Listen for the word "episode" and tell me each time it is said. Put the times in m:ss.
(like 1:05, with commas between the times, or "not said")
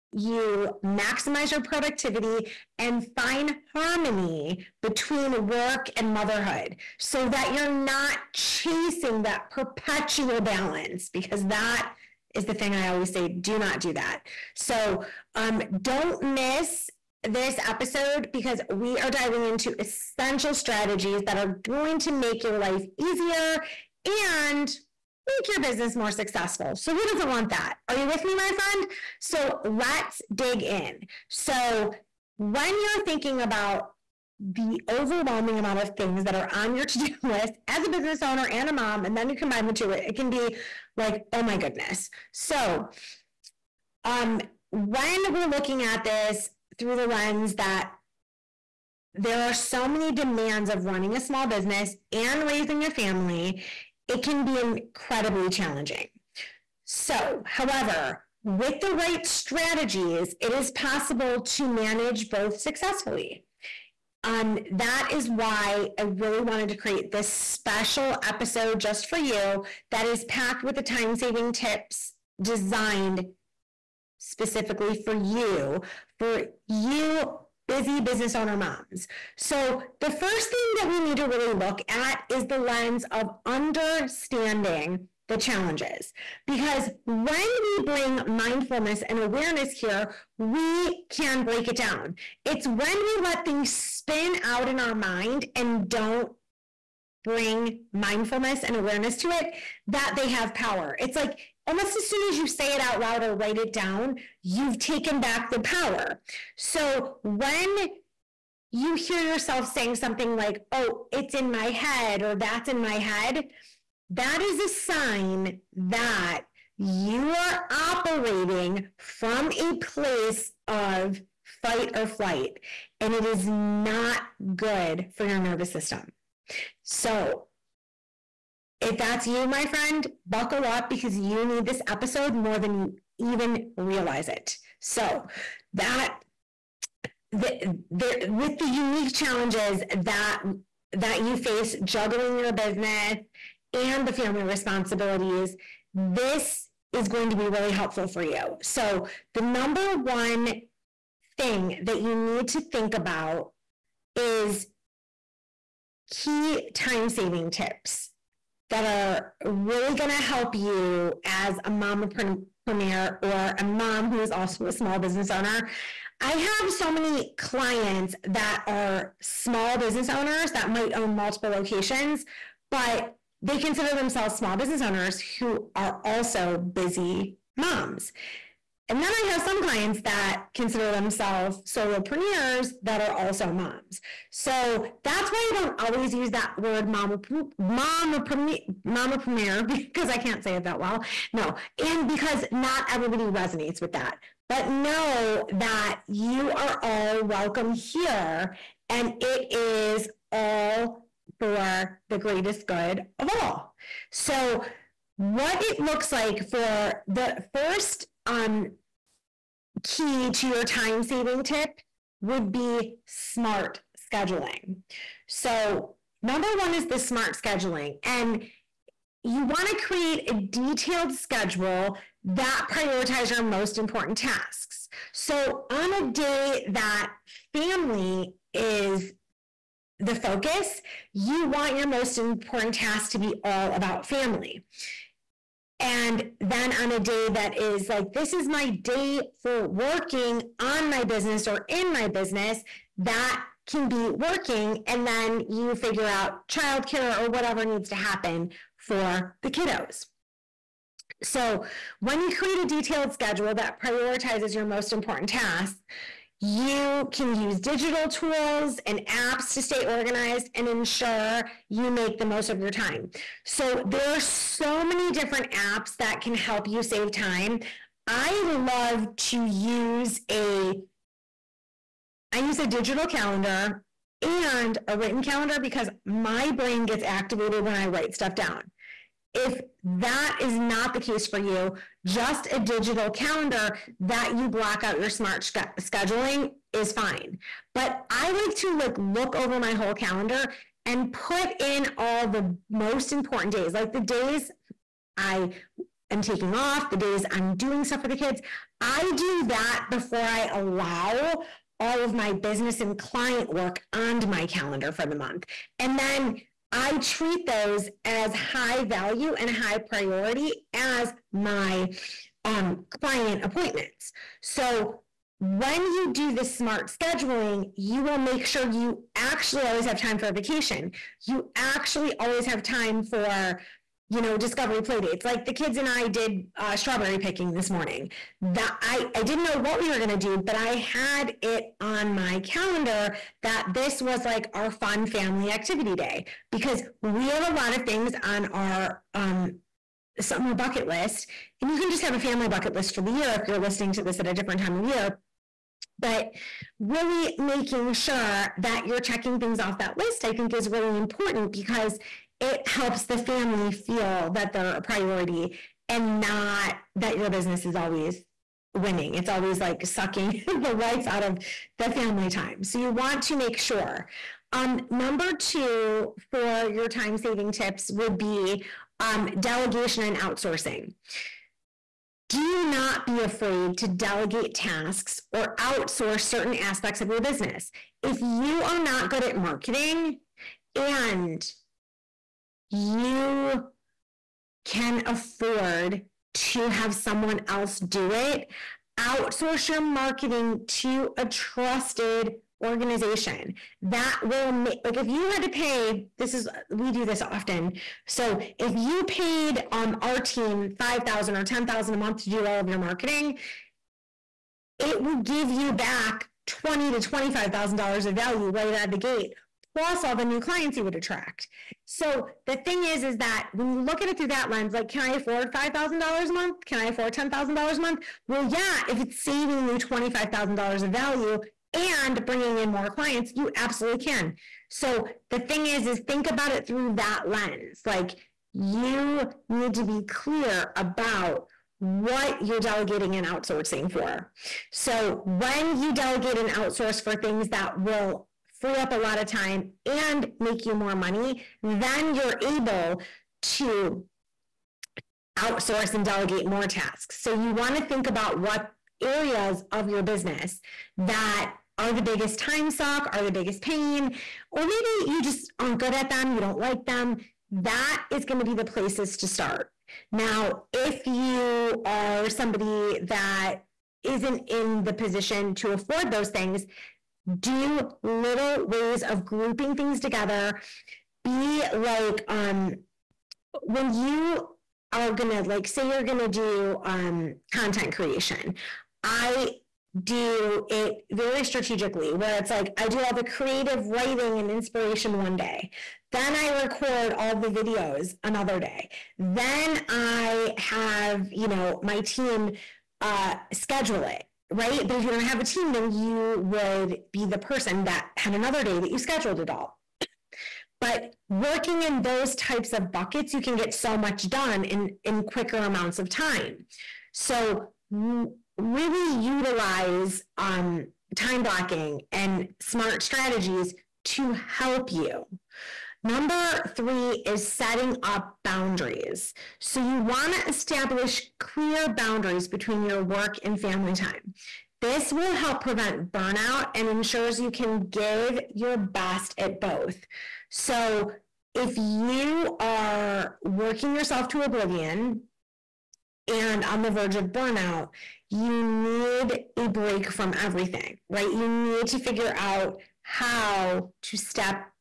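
0:17, 1:08, 2:11.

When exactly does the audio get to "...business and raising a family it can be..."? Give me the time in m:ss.
0:51.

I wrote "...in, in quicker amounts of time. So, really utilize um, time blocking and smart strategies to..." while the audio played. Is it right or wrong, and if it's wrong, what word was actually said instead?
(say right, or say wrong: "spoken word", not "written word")
right.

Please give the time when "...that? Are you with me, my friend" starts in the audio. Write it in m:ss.
0:27.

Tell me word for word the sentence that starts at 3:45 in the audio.
So, on a day that family is the focus, you want your most important tasks to be all about family.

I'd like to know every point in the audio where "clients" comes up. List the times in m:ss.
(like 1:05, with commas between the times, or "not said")
2:47, 2:59, 5:02, 5:13, 6:50, 7:02.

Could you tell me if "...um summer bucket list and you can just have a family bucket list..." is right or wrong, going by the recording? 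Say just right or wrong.
right.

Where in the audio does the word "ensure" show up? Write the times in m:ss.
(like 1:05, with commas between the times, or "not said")
4:20, 8:46.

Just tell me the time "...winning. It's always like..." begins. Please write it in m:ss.
5:58.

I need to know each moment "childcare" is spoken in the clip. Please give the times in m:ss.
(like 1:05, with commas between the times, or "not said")
4:06.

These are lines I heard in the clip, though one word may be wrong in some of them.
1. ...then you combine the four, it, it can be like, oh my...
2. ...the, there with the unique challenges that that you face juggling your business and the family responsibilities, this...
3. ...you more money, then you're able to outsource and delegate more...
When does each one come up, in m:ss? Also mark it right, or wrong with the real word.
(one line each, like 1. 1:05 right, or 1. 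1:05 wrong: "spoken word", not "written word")
1. 0:39 wrong: "two", not "four"
2. 2:17 right
3. 7:20 right.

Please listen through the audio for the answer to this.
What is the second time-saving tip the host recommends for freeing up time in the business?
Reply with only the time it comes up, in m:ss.
6:09.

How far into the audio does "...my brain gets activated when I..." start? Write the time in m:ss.
4:36.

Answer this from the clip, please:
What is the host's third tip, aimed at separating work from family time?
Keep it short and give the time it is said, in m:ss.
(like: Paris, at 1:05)
Setting up boundaries, at 8:37.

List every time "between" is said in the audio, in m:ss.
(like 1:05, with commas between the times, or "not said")
0:04, 8:42.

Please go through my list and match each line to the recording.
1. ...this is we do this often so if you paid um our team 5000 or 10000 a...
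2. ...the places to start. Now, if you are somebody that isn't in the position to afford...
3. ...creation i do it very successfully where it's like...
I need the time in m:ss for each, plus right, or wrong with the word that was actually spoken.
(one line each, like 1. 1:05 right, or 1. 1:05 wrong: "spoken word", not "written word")
1. 6:36 right
2. 7:38 right
3. 7:57 wrong: "strategically", not "successfully".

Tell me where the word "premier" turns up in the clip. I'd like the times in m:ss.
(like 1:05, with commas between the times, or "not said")
2:42, 3:09.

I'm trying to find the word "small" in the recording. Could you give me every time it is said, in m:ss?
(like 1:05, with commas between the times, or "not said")
0:51, 2:44, 2:49, 2:54.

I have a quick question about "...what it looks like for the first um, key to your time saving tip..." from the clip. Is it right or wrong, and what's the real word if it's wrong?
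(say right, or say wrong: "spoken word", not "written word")
right.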